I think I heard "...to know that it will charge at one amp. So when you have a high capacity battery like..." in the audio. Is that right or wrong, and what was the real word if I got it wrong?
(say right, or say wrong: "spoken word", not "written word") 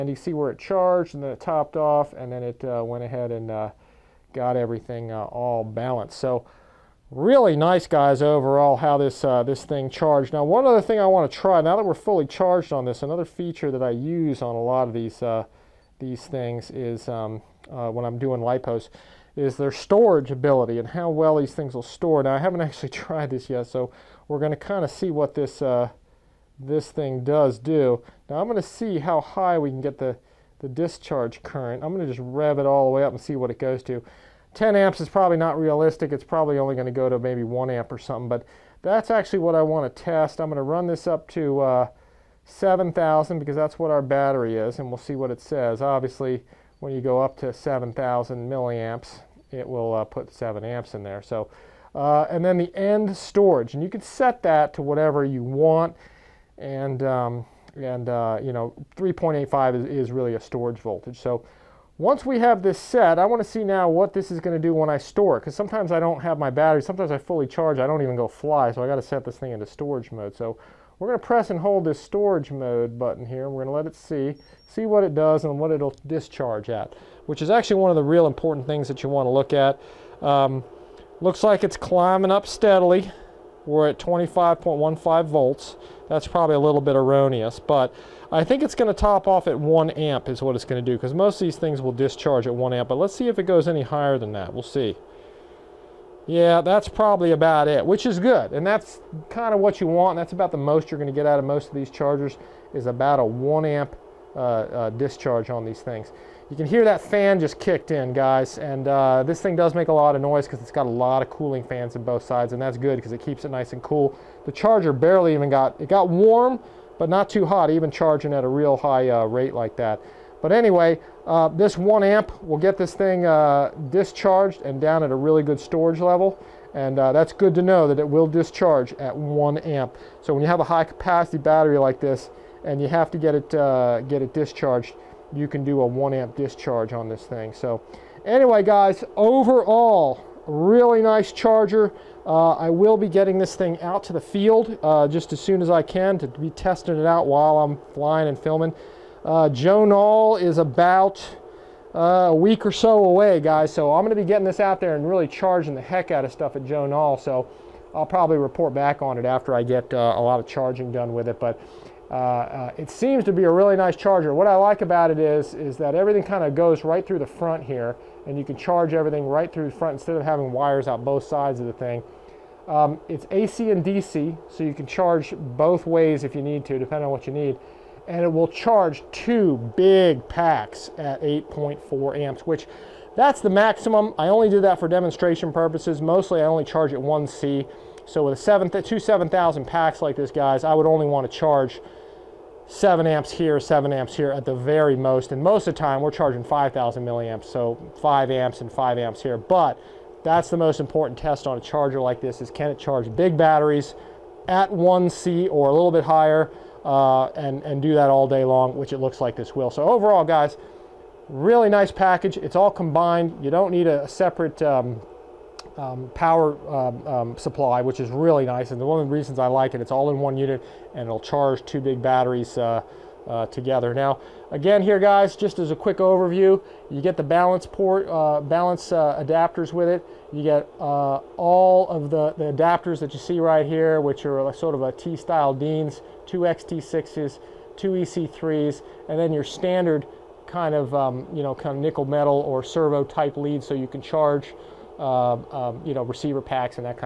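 wrong: "discharge", not "charge".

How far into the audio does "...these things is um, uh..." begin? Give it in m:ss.
0:15.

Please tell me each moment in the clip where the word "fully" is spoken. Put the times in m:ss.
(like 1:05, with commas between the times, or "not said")
0:11, 1:07.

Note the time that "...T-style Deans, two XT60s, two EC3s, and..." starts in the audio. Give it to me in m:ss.
3:54.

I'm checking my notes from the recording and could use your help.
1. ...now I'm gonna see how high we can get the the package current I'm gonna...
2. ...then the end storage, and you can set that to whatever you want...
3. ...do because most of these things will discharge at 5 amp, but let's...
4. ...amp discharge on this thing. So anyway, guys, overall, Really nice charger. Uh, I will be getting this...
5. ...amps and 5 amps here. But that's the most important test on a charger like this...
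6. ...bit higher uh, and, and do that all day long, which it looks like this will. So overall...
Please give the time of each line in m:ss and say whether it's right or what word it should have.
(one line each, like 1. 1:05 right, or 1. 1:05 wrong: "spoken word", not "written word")
1. 0:28 wrong: "discharge", not "package"
2. 0:52 right
3. 1:30 wrong: "1", not "5"
4. 2:16 right
5. 3:18 right
6. 3:25 right.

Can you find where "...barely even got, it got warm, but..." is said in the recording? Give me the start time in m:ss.
1:54.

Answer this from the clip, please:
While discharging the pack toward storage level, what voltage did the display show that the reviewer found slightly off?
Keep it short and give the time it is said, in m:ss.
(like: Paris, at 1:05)
25.15 volts, at 1:23.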